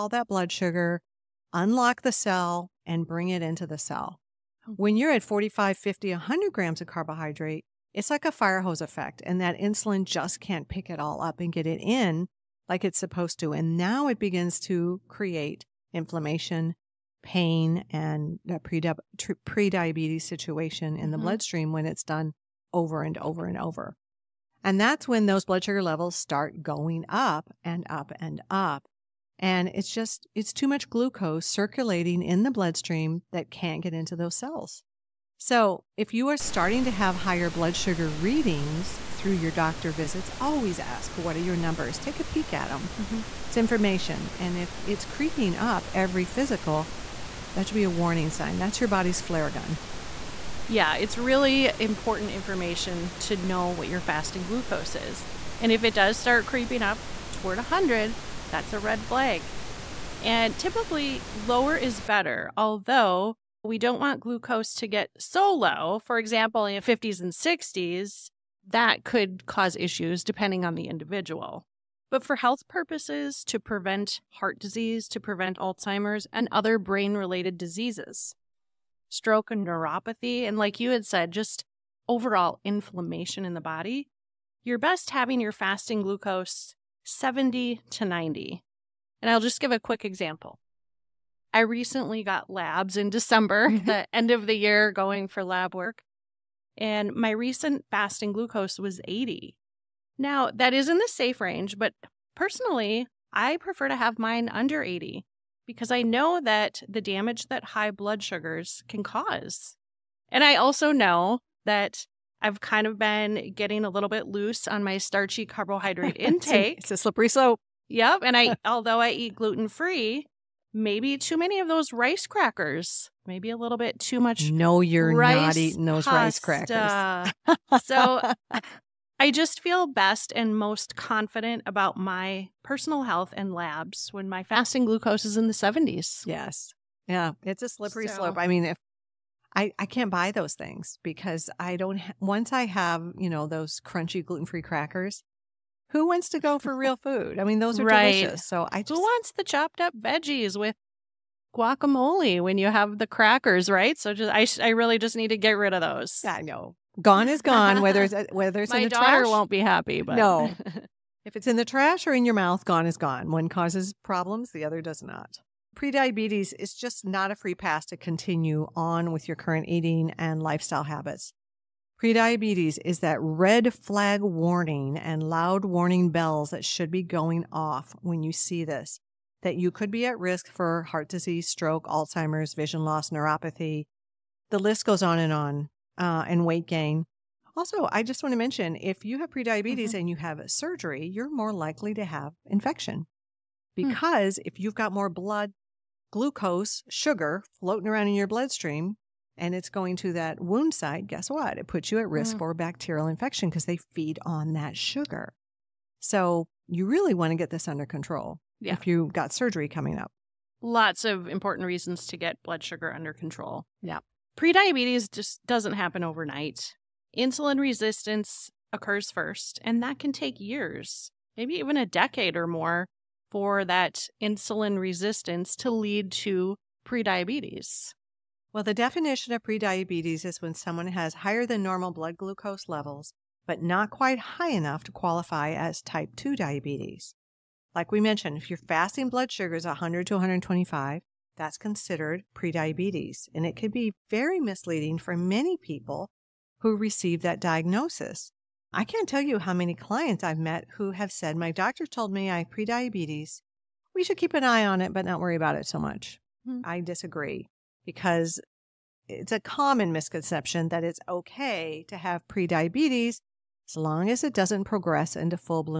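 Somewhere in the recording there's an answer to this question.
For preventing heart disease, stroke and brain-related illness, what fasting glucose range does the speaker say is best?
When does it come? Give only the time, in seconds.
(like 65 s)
87 s.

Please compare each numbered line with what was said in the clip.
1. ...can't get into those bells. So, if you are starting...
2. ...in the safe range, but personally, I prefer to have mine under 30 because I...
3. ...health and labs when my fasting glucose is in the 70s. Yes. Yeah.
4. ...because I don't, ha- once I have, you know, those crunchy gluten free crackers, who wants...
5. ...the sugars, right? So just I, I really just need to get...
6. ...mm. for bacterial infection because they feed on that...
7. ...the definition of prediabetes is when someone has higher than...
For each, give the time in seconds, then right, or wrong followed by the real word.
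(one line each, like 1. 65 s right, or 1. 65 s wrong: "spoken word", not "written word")
1. 33 s wrong: "cells", not "bells"
2. 100 s wrong: "80", not "30"
3. 133 s right
4. 141 s right
5. 152 s wrong: "crackers", not "sugars"
6. 202 s right
7. 228 s right.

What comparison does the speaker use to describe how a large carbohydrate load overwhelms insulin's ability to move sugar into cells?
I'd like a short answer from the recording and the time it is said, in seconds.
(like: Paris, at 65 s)
fire hose effect, at 8 s.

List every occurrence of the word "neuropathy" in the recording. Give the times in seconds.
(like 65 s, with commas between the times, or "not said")
79 s, 183 s.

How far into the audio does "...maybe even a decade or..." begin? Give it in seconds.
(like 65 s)
221 s.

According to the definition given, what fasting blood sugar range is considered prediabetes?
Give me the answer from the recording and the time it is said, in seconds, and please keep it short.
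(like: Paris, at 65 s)
100 to 125, at 239 s.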